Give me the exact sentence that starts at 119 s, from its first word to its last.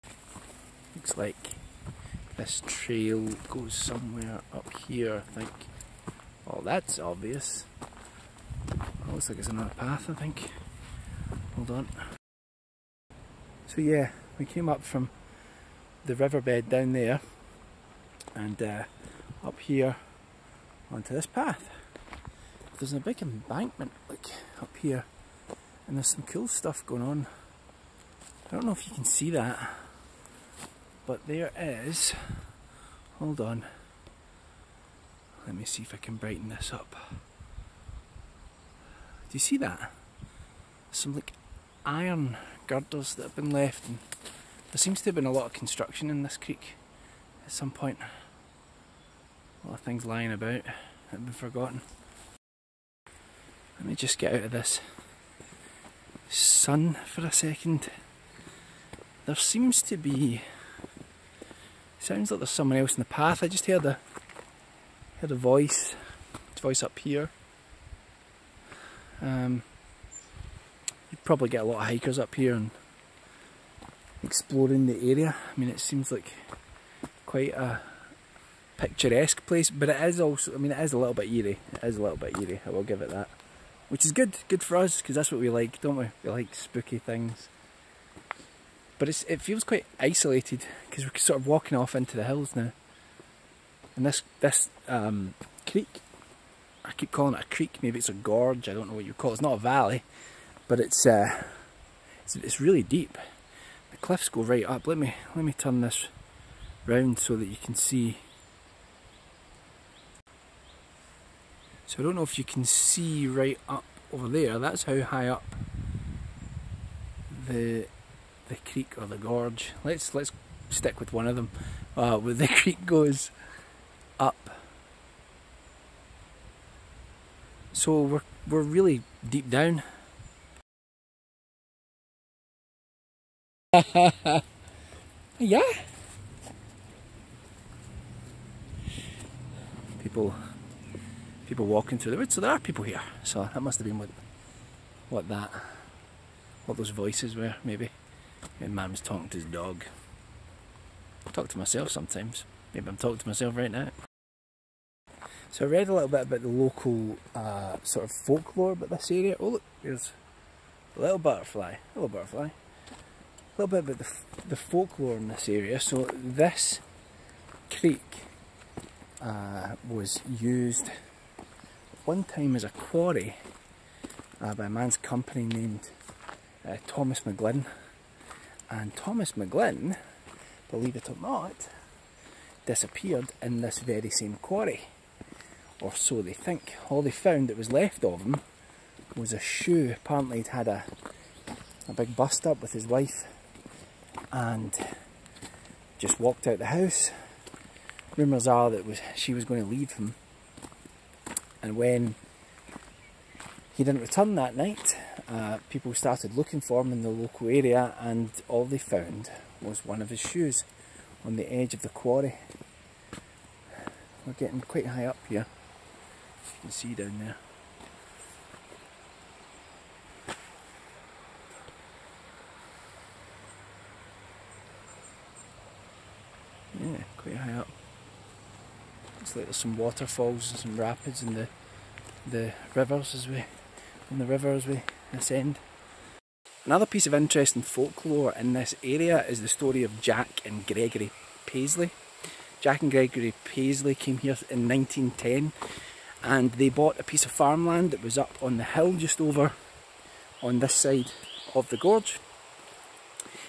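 Let's let's stick with one of them.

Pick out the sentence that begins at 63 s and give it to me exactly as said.
I just heard a heard a voice.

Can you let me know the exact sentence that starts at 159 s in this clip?
Oh look, there's a little butterfly.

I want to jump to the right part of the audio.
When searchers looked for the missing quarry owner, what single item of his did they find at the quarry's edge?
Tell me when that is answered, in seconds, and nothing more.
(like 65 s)
189 s.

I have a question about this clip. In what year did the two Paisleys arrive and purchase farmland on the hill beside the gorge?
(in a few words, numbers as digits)
1910.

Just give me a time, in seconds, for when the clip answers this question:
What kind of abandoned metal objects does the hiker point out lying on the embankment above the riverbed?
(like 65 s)
41 s.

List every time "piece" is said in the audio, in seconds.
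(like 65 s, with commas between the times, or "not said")
236 s, 247 s.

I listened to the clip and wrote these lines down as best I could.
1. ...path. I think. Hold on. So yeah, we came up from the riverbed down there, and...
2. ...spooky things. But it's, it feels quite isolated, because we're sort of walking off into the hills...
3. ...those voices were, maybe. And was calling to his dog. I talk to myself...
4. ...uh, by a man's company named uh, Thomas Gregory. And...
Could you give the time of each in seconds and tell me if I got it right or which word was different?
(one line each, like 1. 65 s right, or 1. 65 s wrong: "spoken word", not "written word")
1. 9 s right
2. 86 s right
3. 146 s wrong: "talking", not "calling"
4. 174 s wrong: "McGlynn", not "Gregory".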